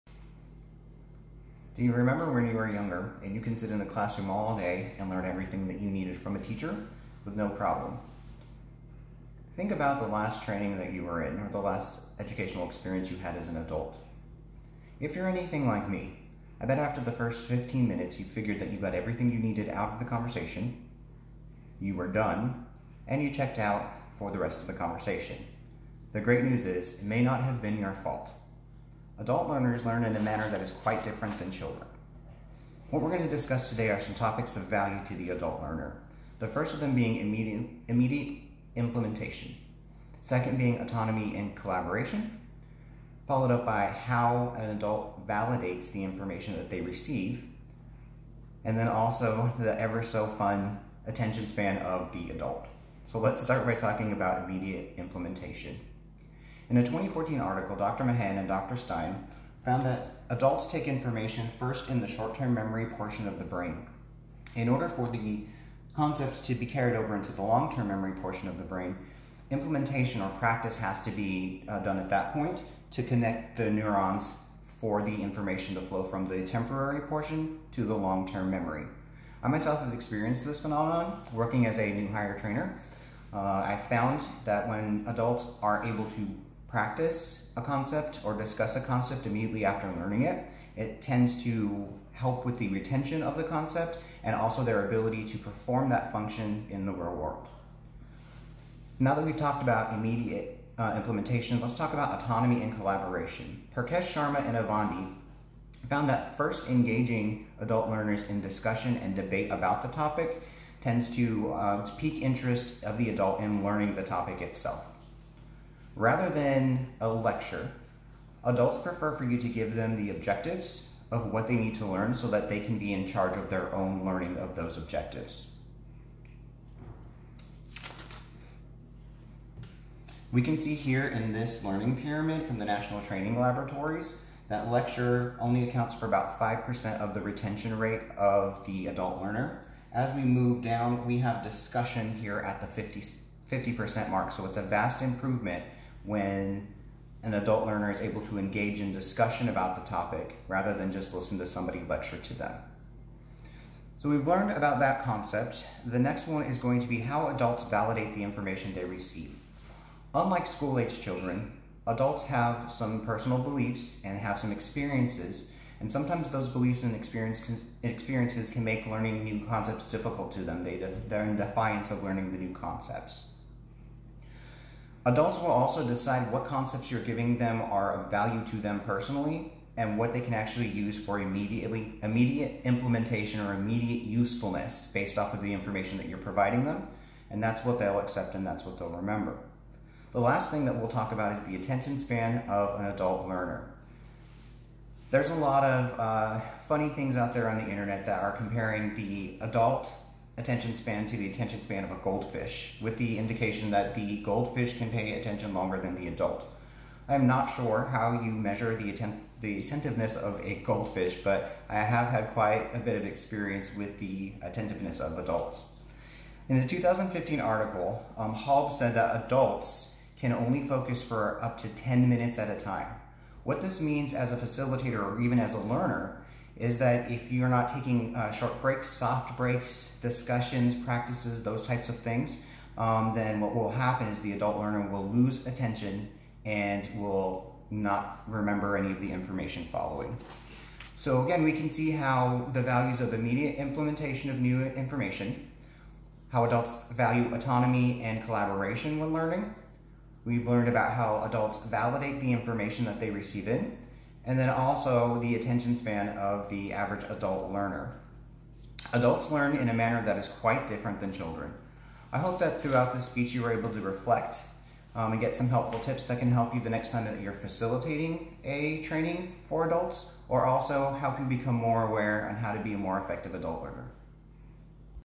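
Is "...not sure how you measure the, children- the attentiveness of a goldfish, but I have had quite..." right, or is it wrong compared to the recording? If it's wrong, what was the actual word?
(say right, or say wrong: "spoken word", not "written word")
wrong: "atten", not "children".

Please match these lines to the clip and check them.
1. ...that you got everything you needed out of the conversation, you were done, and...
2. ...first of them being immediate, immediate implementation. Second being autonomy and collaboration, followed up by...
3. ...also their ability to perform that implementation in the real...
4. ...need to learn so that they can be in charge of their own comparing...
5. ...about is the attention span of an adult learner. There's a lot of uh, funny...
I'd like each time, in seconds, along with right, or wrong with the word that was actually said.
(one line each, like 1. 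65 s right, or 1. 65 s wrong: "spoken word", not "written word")
1. 18 s right
2. 36 s right
3. 94 s wrong: "function", not "implementation"
4. 121 s wrong: "learning", not "comparing"
5. 191 s right.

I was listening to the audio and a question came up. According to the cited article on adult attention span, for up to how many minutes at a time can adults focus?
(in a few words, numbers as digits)
10 minutes.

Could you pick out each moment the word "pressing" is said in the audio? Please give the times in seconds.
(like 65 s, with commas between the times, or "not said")
not said.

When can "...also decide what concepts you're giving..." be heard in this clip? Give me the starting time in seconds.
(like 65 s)
175 s.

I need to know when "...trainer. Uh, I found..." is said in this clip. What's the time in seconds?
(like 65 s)
82 s.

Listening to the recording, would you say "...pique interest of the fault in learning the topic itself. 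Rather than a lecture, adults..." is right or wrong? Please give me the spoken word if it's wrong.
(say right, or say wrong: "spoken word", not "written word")
wrong: "adult", not "fault".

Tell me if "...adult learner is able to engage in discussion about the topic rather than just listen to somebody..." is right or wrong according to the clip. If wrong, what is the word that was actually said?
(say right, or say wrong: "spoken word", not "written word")
right.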